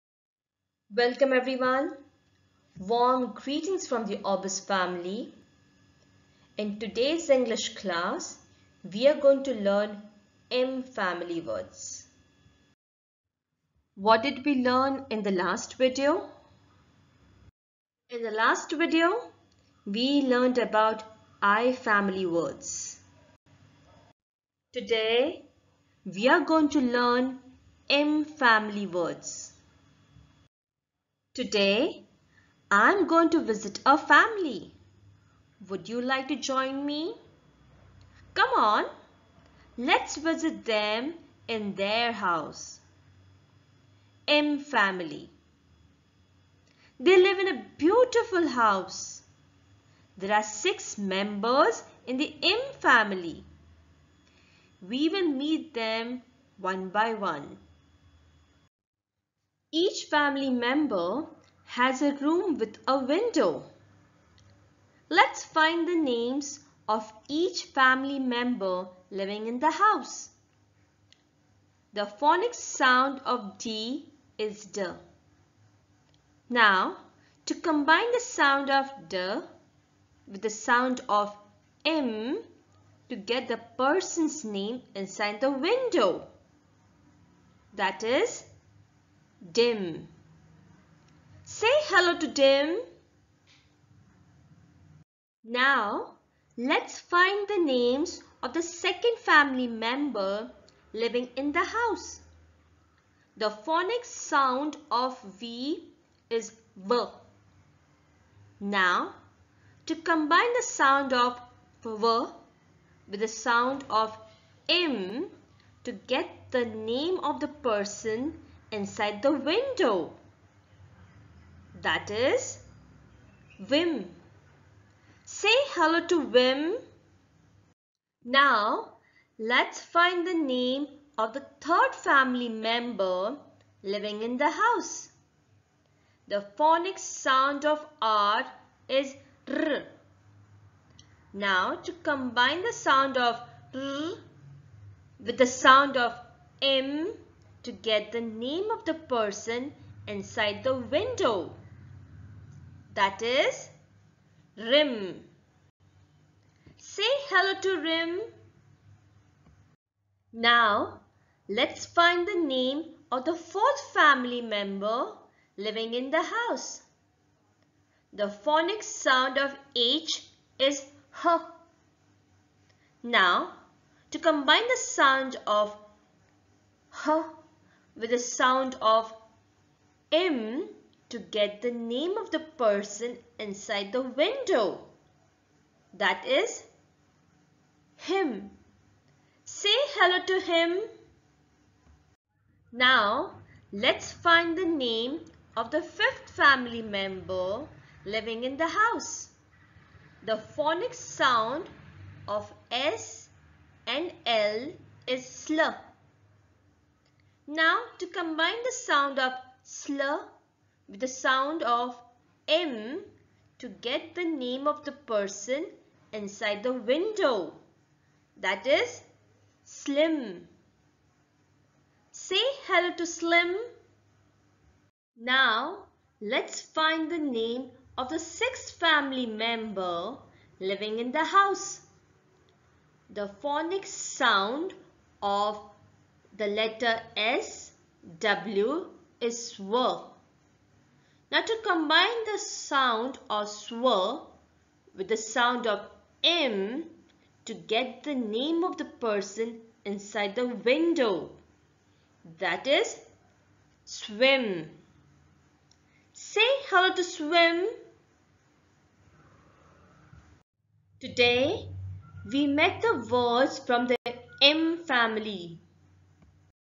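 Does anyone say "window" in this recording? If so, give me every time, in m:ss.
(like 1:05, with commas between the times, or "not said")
1:02, 1:25, 1:59, 2:30, 3:04, 3:36, 4:10.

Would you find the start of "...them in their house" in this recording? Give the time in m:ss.
0:40.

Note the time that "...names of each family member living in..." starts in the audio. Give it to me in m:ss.
1:05.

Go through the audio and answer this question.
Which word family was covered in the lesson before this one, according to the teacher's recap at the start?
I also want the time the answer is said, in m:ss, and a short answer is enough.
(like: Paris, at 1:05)
I family, at 0:21.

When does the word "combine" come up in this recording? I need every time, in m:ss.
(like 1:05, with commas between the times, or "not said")
1:17, 1:49, 2:22, 2:54, 3:28, 4:01.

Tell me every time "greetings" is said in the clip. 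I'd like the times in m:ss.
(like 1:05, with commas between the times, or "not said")
0:03.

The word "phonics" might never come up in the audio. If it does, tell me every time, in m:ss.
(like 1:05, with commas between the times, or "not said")
1:12, 1:43, 2:16, 2:48, 3:20, 3:53.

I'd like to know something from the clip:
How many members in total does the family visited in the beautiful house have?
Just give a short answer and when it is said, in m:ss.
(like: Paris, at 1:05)
6, at 0:50.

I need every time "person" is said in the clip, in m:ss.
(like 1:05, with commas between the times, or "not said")
1:23, 1:57, 2:28, 3:02, 3:34, 4:08.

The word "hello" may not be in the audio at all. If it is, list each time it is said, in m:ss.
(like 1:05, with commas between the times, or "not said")
1:31, 2:05, 2:37, 3:09, 3:42, 4:16.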